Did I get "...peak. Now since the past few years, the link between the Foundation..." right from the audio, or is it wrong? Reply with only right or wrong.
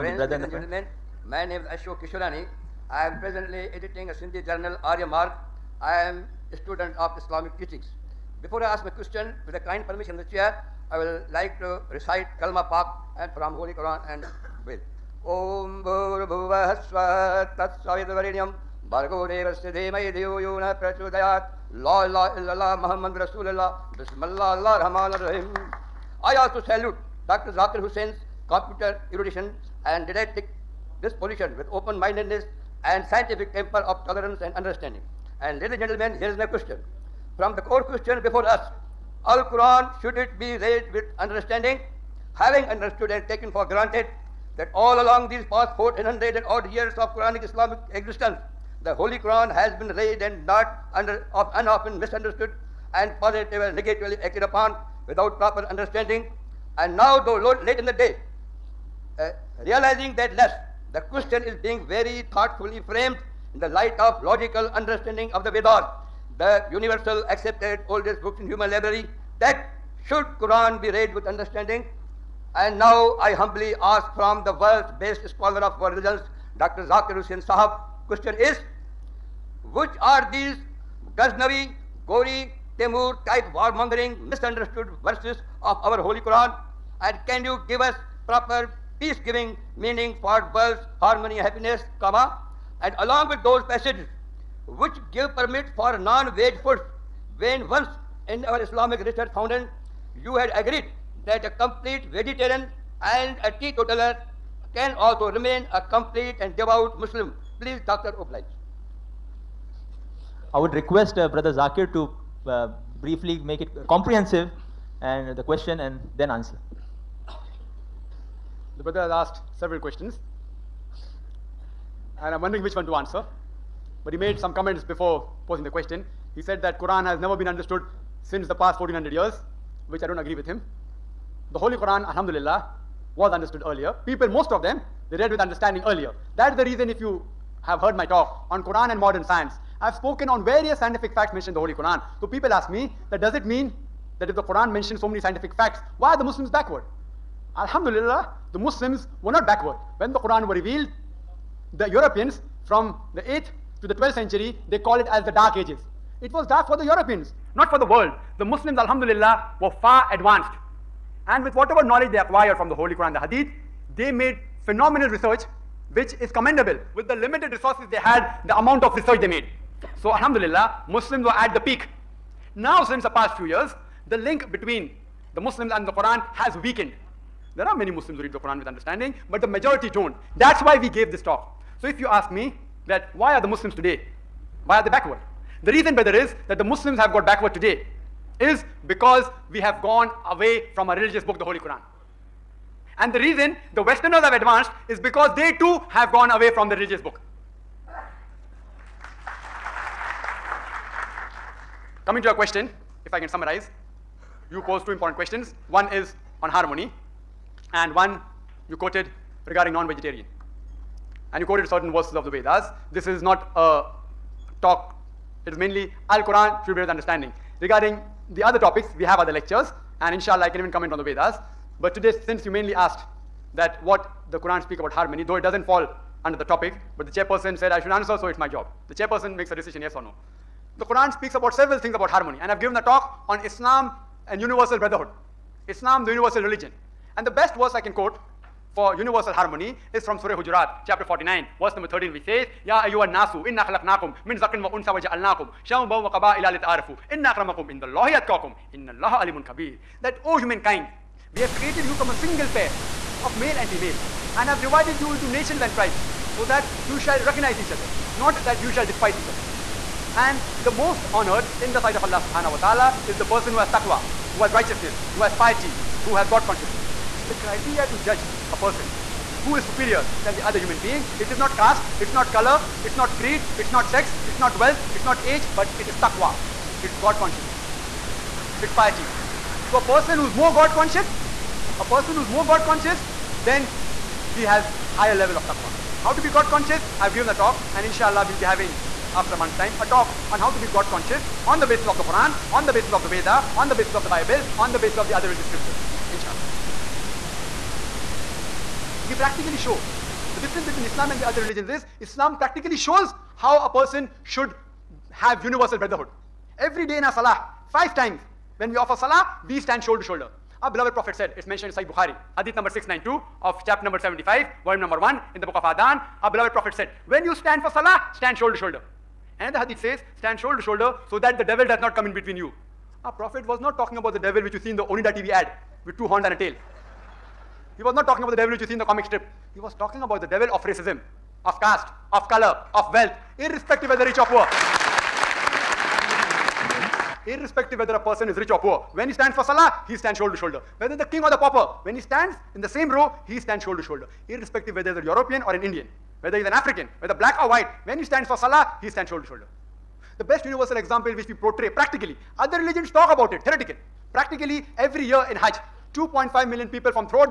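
wrong.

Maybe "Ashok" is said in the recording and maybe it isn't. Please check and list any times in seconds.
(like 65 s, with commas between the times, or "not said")
1 s.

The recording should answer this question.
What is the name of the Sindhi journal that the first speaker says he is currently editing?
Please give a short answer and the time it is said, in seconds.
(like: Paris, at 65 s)
Arya Mark, at 4 s.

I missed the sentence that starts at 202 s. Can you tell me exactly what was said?
Coming to your question, if I can summarize, you posed two important questions.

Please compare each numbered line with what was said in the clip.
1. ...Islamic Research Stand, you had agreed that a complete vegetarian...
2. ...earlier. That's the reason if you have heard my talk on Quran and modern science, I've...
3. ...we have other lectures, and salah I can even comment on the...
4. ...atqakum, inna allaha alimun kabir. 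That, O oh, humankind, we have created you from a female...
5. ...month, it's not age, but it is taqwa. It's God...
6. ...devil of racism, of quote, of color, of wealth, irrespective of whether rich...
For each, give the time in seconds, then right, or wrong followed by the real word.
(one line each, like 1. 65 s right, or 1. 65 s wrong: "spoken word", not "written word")
1. 98 s wrong: "Foundation", not "Stand"
2. 135 s right
3. 218 s wrong: "inshallah", not "salah"
4. 248 s wrong: "single", not "female"
5. 274 s wrong: "wealth", not "month"
6. 330 s wrong: "caste", not "quote".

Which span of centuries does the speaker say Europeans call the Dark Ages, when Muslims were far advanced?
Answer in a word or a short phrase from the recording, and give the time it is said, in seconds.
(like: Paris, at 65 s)
8th to 12th century, at 153 s.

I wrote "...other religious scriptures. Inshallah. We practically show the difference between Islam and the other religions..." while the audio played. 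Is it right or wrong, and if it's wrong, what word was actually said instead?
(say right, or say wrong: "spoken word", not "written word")
right.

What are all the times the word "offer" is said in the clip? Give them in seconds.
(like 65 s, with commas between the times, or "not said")
308 s.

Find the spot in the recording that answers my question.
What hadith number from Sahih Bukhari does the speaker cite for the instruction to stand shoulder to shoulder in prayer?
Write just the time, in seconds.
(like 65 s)
312 s.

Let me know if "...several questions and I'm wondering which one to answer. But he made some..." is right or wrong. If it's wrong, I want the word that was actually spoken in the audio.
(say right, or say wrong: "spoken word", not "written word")
right.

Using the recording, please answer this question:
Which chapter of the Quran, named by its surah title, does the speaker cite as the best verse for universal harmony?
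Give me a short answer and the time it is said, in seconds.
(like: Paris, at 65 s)
Surah Hujurat, at 240 s.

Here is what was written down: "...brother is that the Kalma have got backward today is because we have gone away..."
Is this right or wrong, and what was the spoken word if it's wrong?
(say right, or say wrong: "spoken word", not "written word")
wrong: "Muslims", not "Kalma".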